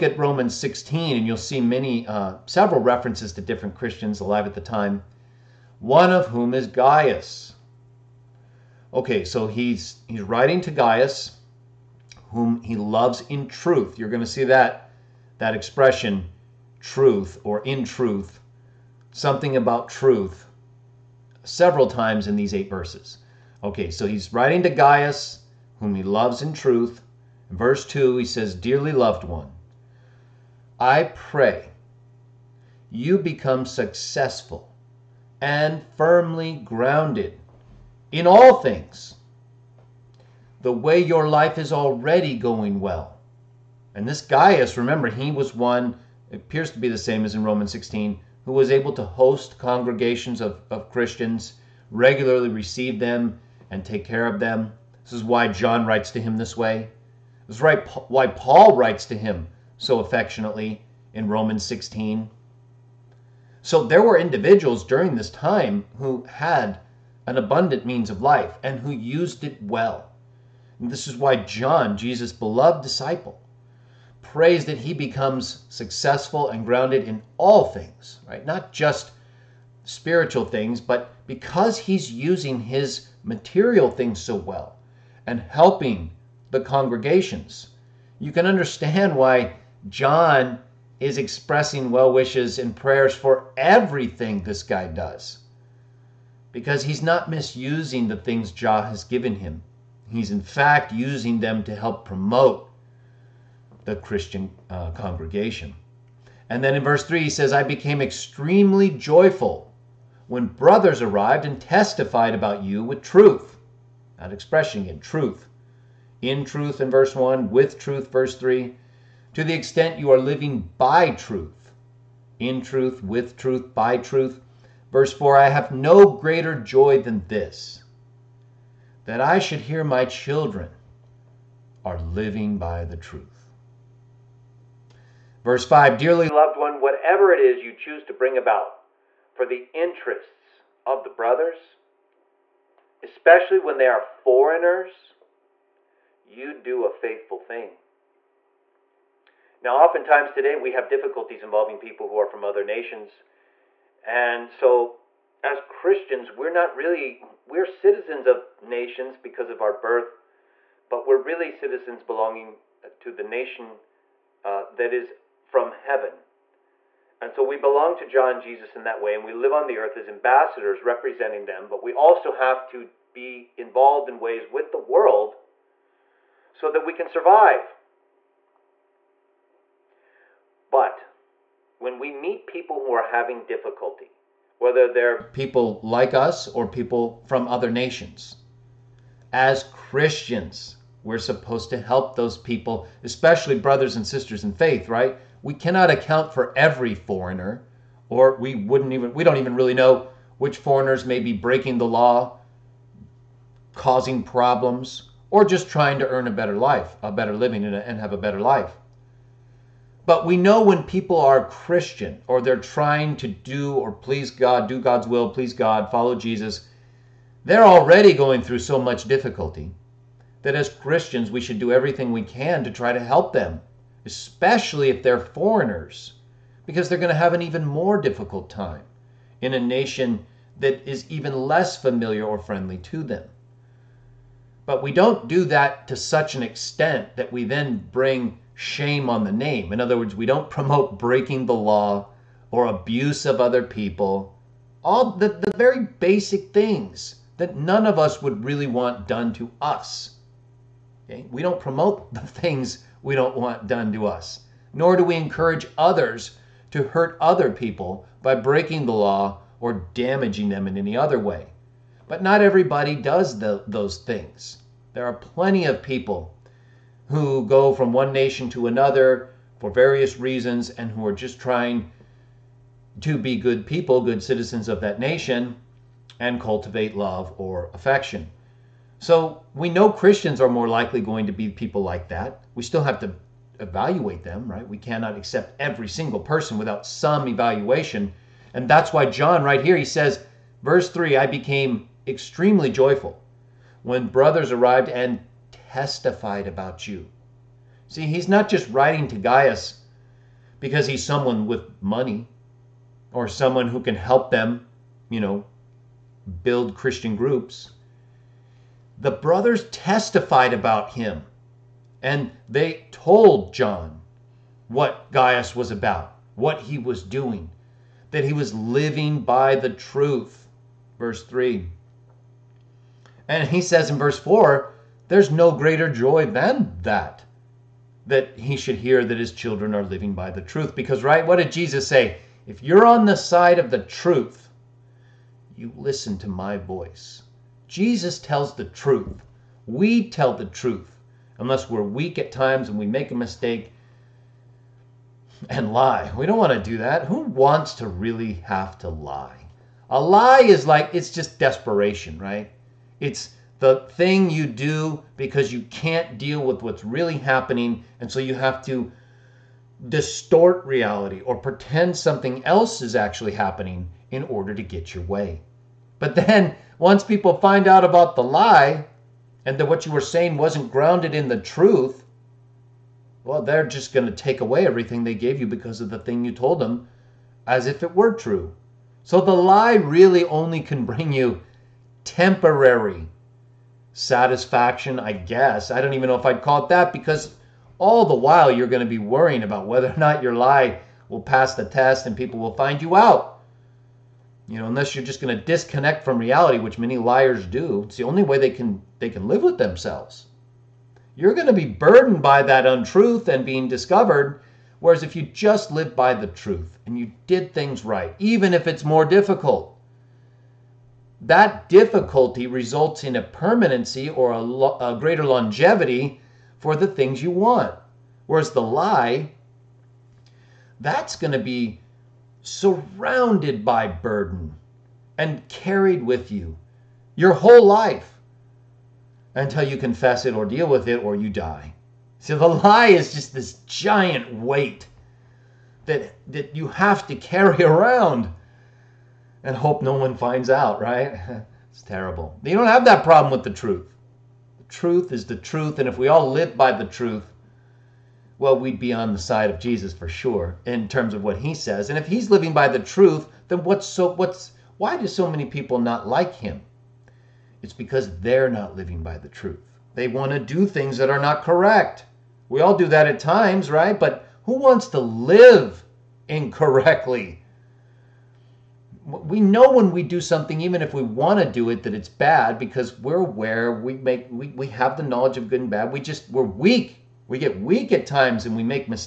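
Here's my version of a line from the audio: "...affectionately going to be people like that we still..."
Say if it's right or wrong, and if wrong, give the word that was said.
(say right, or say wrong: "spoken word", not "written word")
wrong: "likely", not "affectionately".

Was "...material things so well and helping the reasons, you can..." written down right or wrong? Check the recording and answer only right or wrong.
wrong.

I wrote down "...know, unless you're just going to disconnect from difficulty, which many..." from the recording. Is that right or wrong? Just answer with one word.
wrong.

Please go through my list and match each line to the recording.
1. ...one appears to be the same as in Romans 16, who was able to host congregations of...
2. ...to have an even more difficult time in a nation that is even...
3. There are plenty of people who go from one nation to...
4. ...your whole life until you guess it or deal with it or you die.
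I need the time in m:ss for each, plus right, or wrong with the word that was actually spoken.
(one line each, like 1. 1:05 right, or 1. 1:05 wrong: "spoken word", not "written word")
1. 0:45 right
2. 3:47 right
3. 4:24 right
4. 7:07 wrong: "confess", not "guess".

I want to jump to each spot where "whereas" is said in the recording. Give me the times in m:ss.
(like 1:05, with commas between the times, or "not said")
6:44, 6:58.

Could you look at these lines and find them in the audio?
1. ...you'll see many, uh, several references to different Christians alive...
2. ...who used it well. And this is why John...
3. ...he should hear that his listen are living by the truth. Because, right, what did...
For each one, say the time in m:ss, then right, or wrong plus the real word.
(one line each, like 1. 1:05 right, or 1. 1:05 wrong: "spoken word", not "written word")
1. 0:01 right
2. 1:08 right
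3. 5:28 wrong: "children", not "listen".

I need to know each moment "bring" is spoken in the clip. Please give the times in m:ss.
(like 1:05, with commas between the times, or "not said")
2:18, 3:57, 6:20.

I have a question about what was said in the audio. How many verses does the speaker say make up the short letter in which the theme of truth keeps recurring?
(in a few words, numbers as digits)
8.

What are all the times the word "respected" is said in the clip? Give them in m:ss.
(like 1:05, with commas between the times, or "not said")
not said.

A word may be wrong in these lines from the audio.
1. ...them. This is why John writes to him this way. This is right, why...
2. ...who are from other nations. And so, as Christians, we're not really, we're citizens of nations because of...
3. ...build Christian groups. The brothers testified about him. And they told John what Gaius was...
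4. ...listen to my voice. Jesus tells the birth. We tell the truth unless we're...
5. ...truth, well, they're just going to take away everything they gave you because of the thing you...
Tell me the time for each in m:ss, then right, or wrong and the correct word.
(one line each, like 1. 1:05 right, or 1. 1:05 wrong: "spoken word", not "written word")
1. 0:54 right
2. 2:32 right
3. 5:06 right
4. 5:35 wrong: "truth", not "birth"
5. 6:11 right.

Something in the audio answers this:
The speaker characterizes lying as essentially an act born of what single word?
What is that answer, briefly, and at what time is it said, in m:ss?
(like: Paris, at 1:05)
desperation, at 5:51.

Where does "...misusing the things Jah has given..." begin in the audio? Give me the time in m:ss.
1:37.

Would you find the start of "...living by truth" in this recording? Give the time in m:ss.
2:00.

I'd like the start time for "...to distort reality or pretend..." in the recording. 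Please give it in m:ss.
5:58.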